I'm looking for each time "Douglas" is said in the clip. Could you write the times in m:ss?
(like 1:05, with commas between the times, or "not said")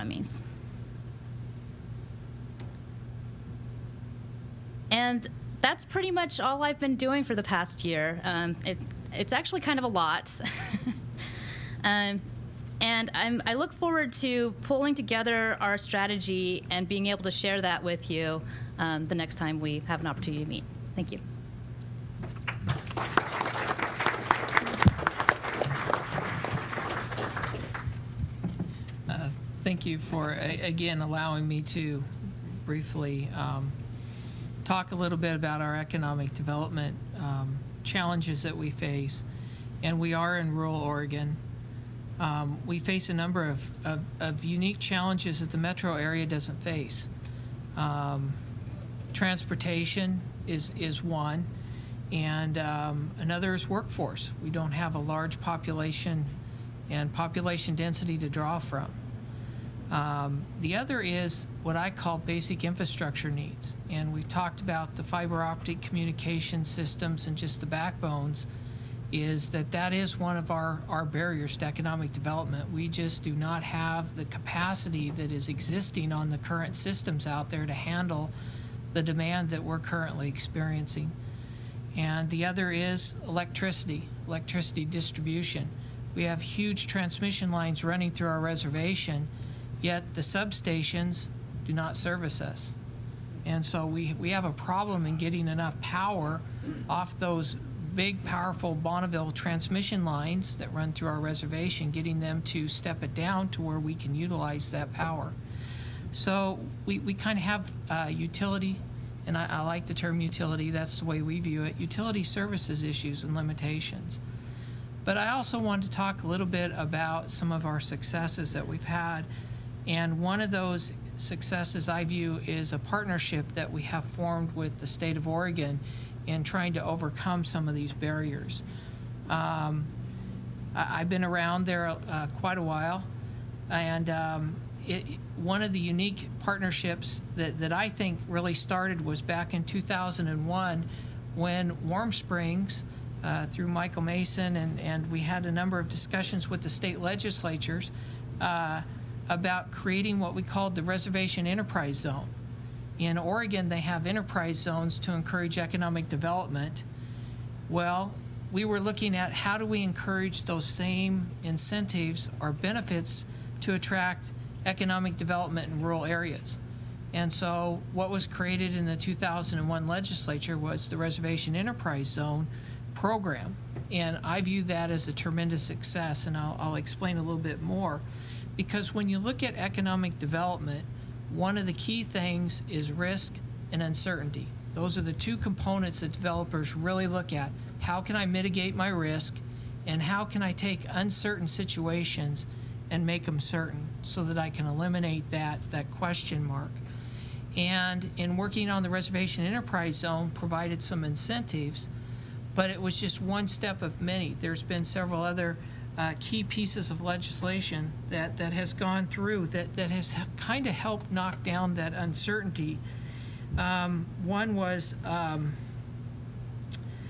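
not said.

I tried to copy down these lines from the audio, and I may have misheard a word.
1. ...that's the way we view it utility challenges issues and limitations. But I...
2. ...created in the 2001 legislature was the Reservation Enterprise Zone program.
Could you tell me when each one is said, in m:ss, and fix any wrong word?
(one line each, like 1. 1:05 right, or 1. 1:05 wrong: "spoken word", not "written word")
1. 1:50 wrong: "services", not "challenges"
2. 2:48 right.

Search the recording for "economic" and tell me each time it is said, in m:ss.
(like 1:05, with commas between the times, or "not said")
0:35, 1:11, 2:35, 2:44, 2:59.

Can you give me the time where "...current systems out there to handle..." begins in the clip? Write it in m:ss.
1:16.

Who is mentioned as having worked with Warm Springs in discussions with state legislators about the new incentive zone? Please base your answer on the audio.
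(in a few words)
Michael Mason.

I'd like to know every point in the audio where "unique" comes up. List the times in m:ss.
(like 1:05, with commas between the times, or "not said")
0:44, 2:15.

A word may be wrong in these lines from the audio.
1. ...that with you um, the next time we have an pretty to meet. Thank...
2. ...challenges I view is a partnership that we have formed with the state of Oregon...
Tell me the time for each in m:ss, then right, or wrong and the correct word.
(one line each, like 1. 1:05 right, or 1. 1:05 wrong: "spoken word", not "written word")
1. 0:17 wrong: "opportunity", not "pretty"
2. 2:01 wrong: "successes", not "challenges".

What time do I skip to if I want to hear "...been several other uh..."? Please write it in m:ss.
3:24.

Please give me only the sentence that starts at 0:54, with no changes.
We don't have a large population and population density to draw from.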